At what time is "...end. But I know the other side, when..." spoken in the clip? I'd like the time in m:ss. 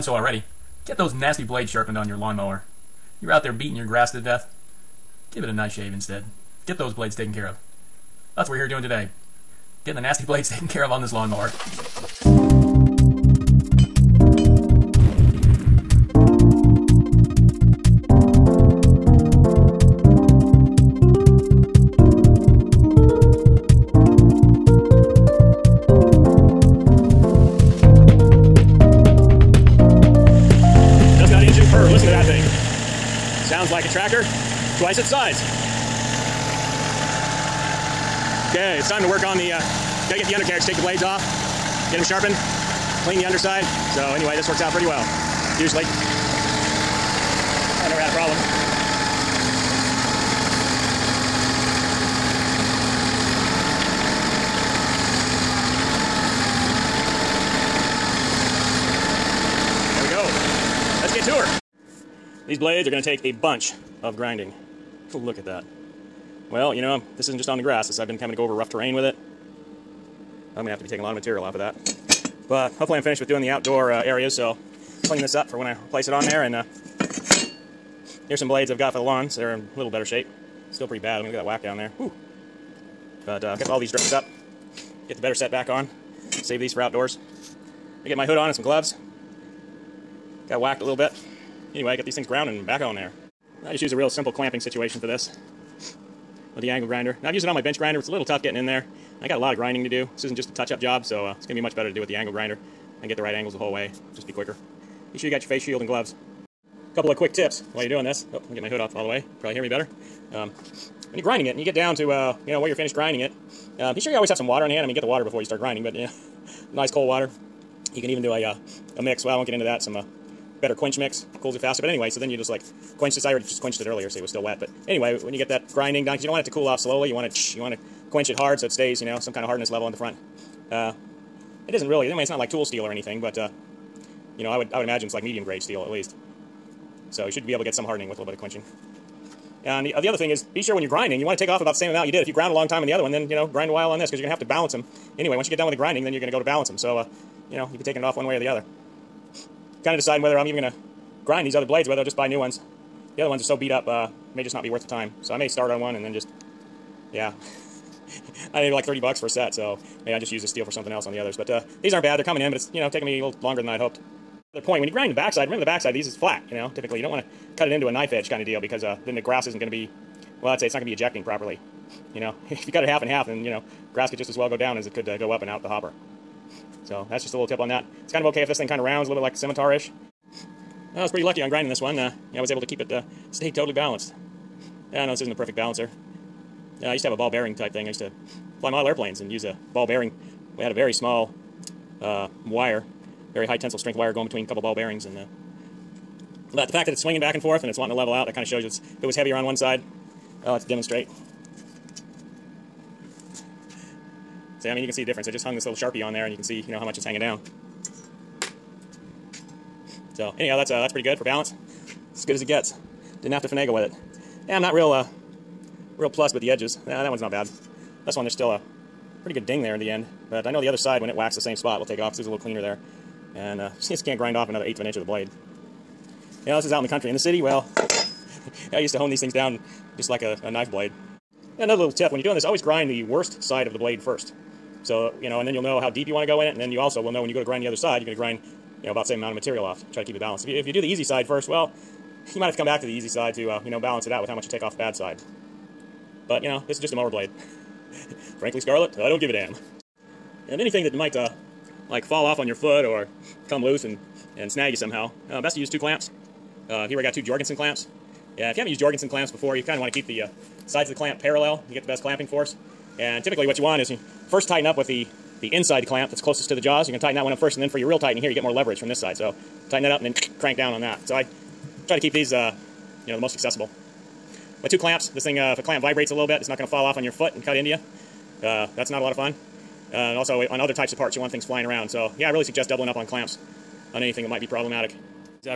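3:39.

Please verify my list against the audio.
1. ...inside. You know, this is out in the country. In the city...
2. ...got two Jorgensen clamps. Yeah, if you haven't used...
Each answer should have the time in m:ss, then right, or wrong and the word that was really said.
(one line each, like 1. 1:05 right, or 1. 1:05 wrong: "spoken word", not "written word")
1. 3:45 wrong: "blade", not "inside"
2. 4:17 right.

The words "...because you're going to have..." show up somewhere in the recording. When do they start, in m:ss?
2:24.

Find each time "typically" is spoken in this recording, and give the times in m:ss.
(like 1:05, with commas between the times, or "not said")
2:46, 4:23.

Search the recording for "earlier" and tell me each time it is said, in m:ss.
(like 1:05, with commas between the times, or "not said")
2:03.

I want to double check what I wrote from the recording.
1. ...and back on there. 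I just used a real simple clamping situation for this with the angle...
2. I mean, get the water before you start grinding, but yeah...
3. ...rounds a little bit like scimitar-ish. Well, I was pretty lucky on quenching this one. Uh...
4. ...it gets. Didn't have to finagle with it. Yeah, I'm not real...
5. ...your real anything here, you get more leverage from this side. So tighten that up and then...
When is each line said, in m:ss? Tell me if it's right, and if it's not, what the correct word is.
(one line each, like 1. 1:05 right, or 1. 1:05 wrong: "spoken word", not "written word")
1. 1:32 right
2. 1:54 right
3. 2:58 wrong: "grinding", not "quenching"
4. 3:32 right
5. 4:27 wrong: "tightening", not "anything".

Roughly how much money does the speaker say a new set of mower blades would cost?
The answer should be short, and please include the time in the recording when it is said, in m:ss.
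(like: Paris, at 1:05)
30 bucks, at 2:38.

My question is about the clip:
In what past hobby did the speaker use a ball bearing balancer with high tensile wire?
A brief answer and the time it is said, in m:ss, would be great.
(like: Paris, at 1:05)
model airplanes, at 3:08.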